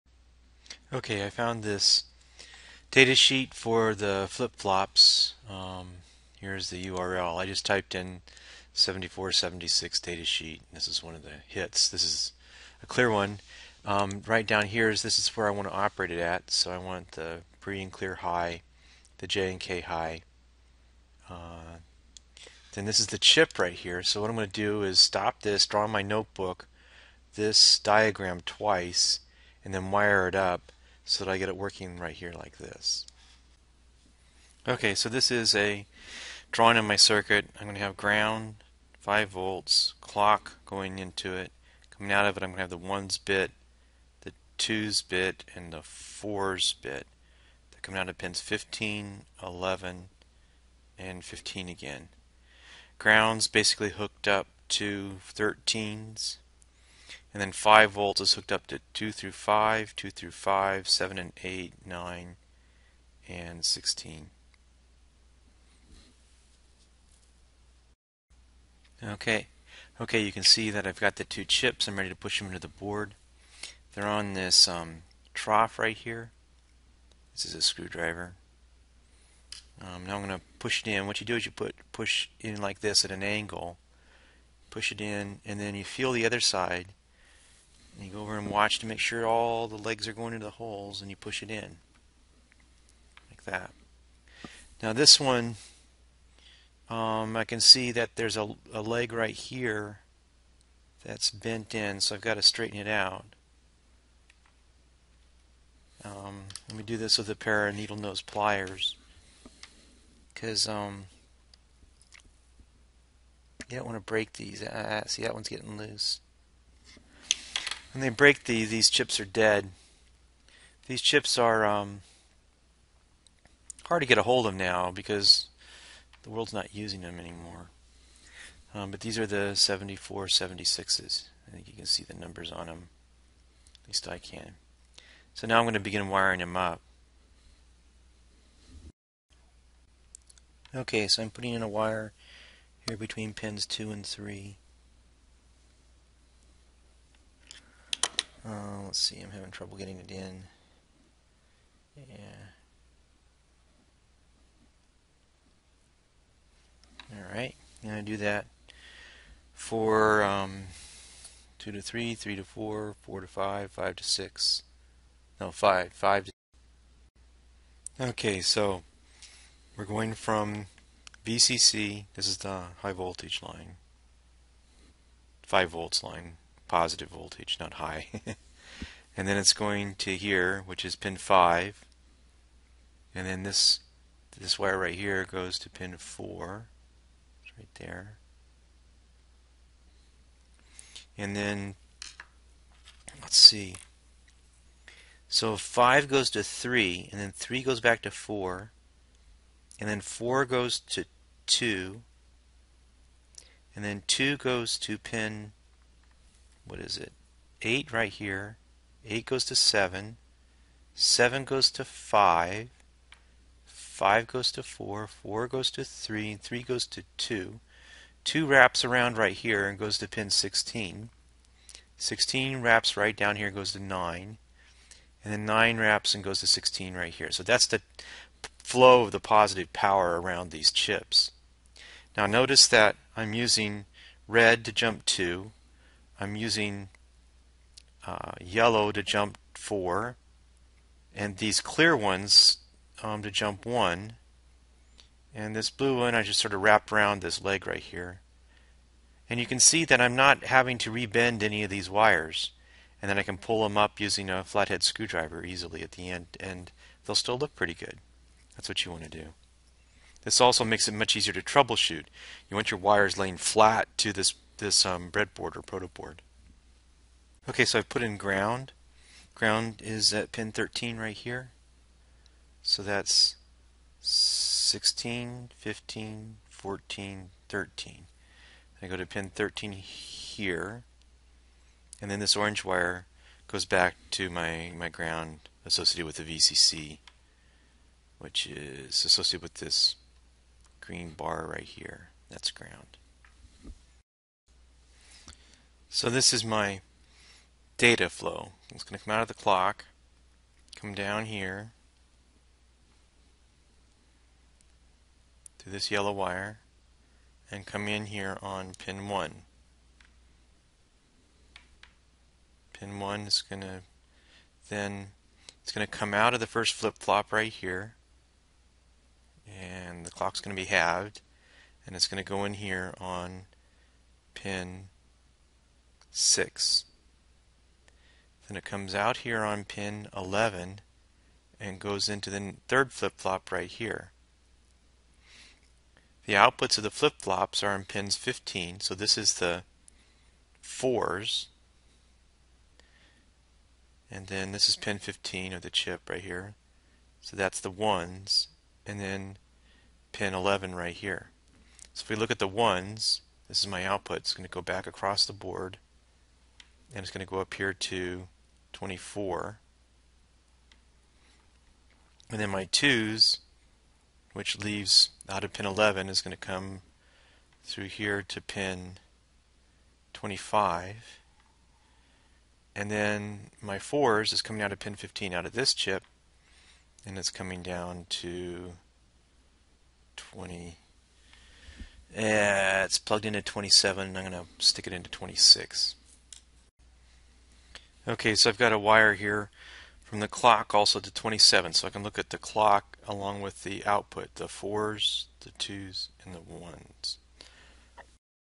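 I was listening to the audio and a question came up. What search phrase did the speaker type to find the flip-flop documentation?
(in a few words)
7476 data sheet.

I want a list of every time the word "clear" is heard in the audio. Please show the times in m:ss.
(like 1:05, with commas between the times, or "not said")
0:12, 0:17, 4:01.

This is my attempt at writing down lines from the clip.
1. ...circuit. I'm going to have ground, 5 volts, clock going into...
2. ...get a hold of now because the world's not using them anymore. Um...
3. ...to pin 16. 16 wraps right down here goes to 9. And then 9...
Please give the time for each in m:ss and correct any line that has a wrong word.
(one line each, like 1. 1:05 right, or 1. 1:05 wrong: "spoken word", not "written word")
1. 0:36 right
2. 2:04 right
3. 3:39 right.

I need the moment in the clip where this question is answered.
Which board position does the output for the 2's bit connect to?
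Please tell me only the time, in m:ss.
6:08.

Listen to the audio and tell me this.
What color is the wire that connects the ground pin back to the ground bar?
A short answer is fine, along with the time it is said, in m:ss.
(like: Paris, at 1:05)
orange, at 4:42.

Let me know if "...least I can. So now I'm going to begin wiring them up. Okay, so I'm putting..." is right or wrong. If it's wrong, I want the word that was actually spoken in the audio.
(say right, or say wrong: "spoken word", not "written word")
right.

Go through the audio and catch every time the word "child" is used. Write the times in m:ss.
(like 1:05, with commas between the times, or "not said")
not said.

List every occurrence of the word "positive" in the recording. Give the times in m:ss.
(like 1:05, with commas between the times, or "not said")
2:56, 3:49.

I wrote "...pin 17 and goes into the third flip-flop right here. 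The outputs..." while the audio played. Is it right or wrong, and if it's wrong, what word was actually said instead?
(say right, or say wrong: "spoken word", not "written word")
wrong: "11", not "17".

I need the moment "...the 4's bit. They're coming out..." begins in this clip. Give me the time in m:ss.
0:45.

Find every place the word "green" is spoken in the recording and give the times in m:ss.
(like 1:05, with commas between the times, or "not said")
4:50.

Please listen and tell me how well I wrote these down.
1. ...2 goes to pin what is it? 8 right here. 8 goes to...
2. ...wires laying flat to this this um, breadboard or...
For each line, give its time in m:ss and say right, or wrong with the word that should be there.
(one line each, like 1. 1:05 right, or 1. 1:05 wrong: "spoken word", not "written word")
1. 3:24 right
2. 4:22 right.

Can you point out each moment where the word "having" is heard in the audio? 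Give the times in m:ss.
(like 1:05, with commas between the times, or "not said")
2:29, 4:10.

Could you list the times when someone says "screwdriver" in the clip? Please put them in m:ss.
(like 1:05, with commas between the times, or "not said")
1:17, 4:14.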